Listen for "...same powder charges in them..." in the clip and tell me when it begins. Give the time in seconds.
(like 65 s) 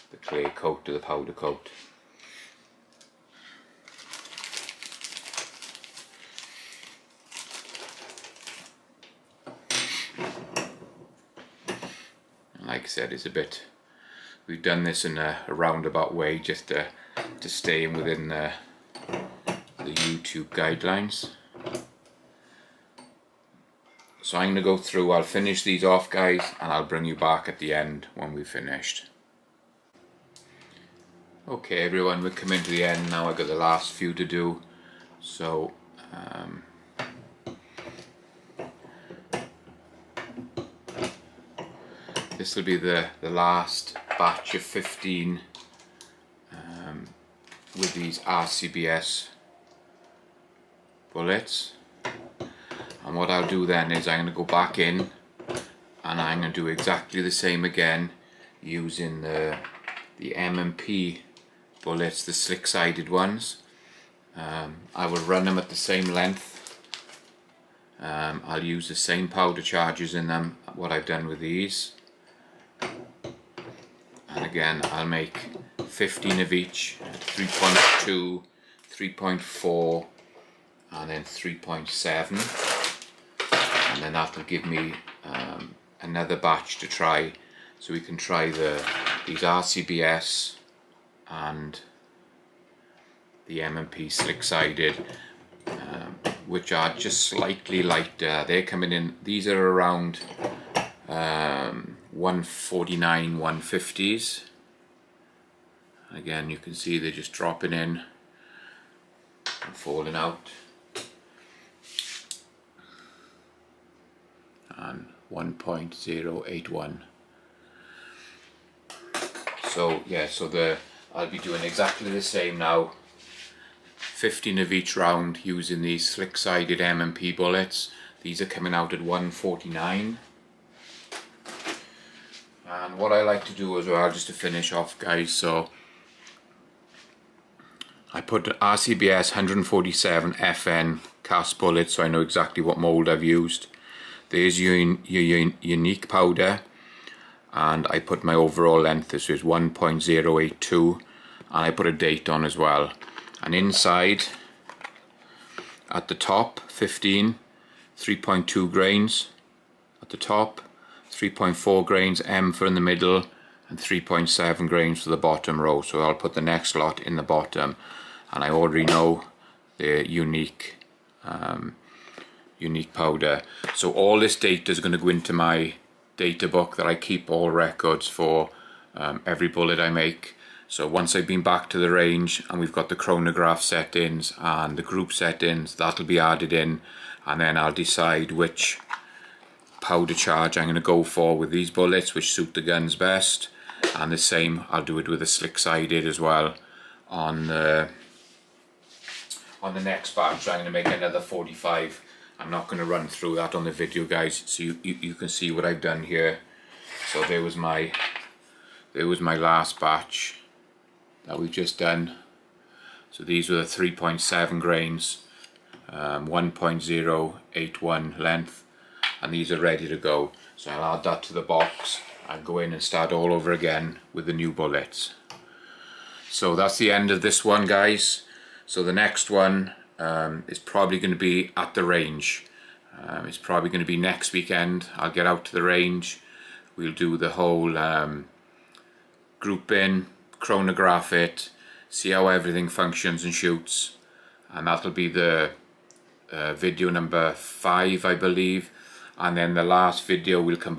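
68 s.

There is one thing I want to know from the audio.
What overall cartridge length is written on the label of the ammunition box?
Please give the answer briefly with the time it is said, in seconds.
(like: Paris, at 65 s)
1.082, at 149 s.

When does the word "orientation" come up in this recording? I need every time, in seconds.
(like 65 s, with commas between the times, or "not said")
not said.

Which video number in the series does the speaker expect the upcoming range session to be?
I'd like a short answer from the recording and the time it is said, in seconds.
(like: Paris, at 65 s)
5, at 246 s.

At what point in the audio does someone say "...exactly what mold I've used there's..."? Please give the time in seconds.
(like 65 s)
142 s.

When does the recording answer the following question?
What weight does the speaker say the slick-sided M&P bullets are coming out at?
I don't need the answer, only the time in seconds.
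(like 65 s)
128 s.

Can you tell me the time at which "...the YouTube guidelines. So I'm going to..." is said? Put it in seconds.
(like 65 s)
19 s.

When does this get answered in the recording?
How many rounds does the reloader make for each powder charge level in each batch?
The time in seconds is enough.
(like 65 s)
123 s.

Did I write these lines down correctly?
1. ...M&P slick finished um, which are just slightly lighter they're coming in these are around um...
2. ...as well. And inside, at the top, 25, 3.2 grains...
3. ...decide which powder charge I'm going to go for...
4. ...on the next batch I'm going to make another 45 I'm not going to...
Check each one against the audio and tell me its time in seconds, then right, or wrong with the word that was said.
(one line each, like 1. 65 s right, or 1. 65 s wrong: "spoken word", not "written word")
1. 93 s wrong: "sided", not "finished"
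2. 152 s wrong: "15", not "25"
3. 187 s right
4. 199 s right.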